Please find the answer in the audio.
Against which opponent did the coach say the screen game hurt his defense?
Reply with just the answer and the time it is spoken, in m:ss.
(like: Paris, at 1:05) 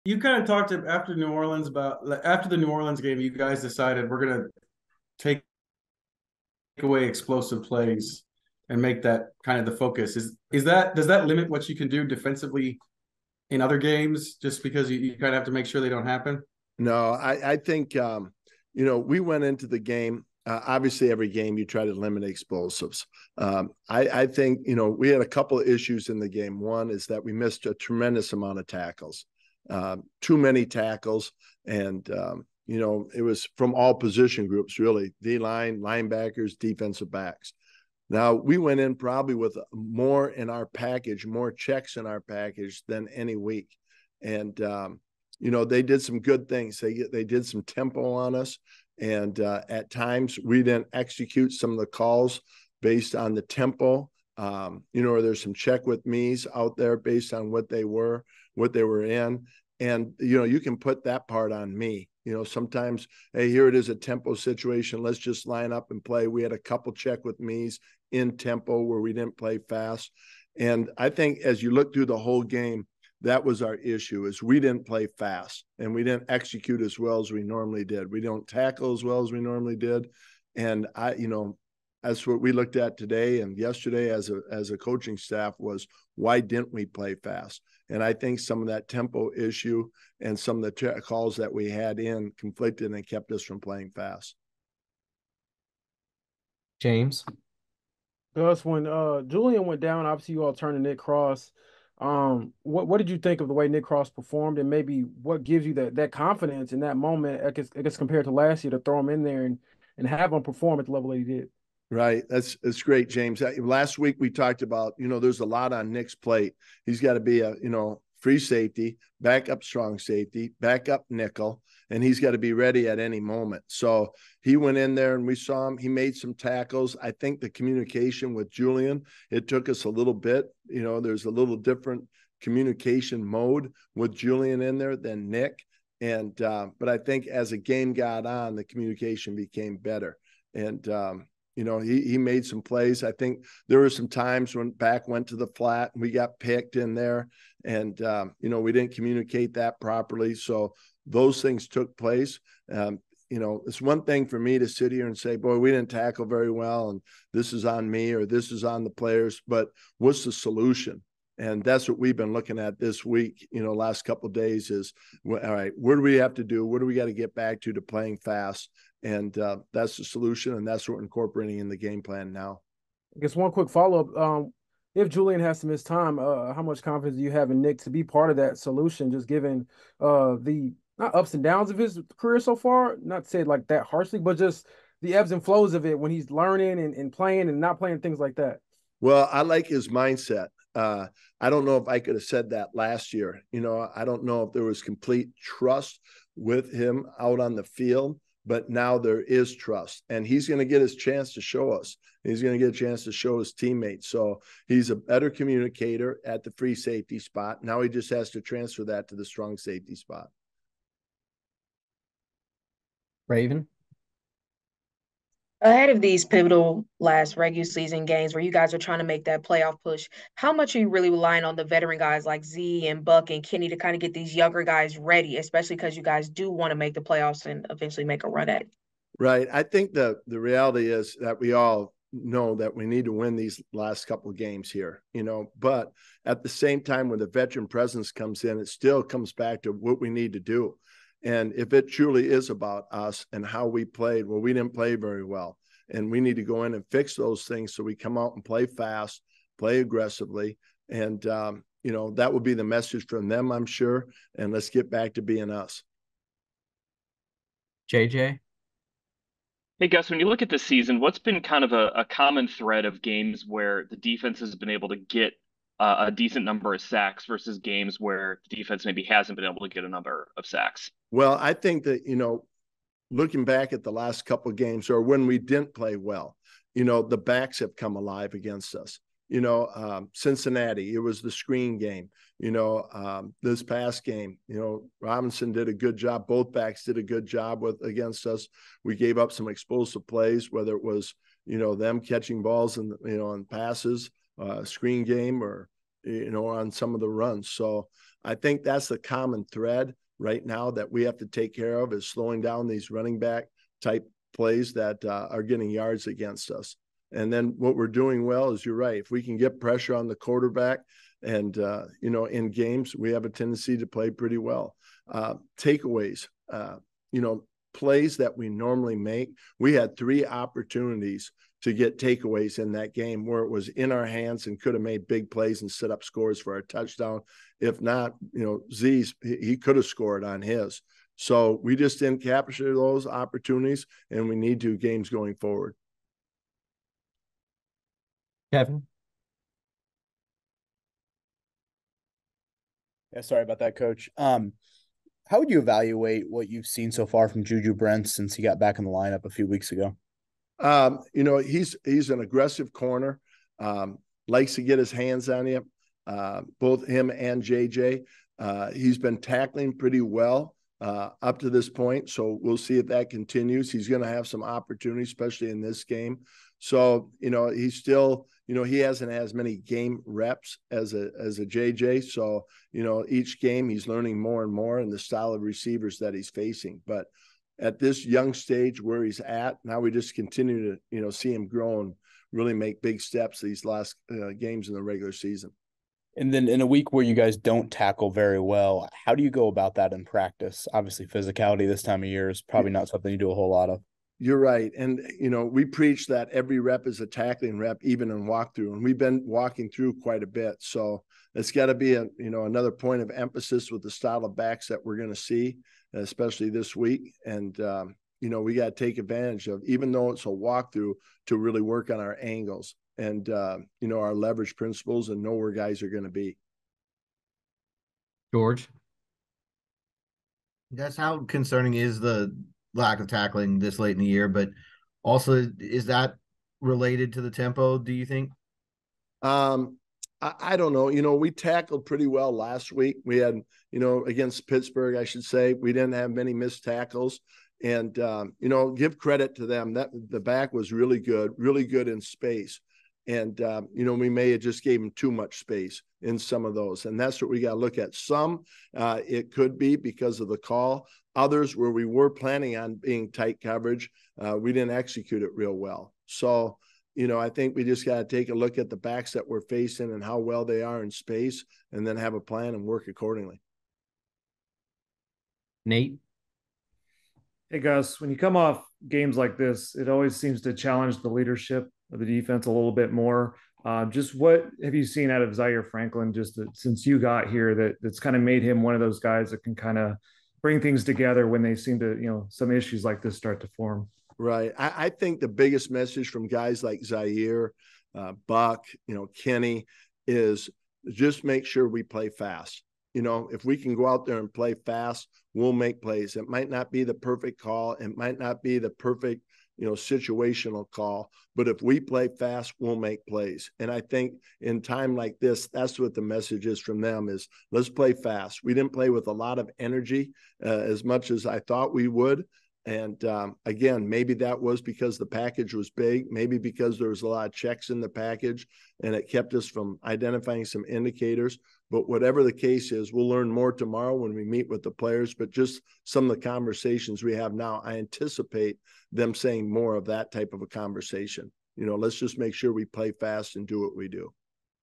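Cincinnati, at 4:40.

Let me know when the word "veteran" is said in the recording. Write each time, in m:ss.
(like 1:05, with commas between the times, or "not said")
3:41, 3:57.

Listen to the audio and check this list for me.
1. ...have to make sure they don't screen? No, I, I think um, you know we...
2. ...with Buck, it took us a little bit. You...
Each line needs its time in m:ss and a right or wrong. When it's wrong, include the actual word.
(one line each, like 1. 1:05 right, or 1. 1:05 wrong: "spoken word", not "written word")
1. 0:15 wrong: "happen", not "screen"
2. 2:08 wrong: "Julian", not "Buck".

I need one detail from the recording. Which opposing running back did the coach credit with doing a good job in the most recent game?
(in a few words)
Robinson.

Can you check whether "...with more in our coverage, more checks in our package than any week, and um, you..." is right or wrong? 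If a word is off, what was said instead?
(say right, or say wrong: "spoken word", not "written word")
wrong: "package", not "coverage".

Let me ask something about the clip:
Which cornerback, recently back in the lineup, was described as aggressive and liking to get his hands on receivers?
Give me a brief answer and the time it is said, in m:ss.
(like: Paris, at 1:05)
Juju Brents, at 5:47.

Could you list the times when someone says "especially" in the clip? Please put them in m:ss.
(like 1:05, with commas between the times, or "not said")
3:45, 6:05, 6:45.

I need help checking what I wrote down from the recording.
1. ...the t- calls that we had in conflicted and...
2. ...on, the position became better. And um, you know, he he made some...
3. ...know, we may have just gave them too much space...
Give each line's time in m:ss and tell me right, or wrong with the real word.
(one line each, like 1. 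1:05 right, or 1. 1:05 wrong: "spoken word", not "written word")
1. 1:30 right
2. 2:18 wrong: "communication", not "position"
3. 7:23 right.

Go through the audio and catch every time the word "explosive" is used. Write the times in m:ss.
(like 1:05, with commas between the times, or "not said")
0:07, 0:22, 4:49.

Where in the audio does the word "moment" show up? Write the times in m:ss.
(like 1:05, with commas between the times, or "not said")
1:46, 2:03.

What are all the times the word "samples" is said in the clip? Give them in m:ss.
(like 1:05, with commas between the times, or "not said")
not said.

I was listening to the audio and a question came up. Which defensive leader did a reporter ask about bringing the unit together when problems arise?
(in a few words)
Zaire Franklin.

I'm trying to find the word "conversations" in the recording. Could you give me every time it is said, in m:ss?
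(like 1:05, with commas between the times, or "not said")
8:46, 8:50.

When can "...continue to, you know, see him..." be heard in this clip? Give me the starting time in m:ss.
6:20.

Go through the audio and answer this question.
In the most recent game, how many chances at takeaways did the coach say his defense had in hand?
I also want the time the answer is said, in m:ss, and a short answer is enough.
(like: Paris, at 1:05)
3, at 5:19.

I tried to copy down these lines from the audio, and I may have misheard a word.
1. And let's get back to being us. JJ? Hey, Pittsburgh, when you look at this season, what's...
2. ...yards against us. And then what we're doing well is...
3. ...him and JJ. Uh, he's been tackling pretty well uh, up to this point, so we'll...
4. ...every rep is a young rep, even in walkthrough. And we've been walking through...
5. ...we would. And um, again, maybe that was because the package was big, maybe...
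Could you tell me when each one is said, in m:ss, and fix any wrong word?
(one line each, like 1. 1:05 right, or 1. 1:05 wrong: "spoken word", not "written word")
1. 4:14 wrong: "Gus", not "Pittsburgh"
2. 5:05 right
3. 5:56 right
4. 6:36 wrong: "tackling", not "young"
5. 8:31 right.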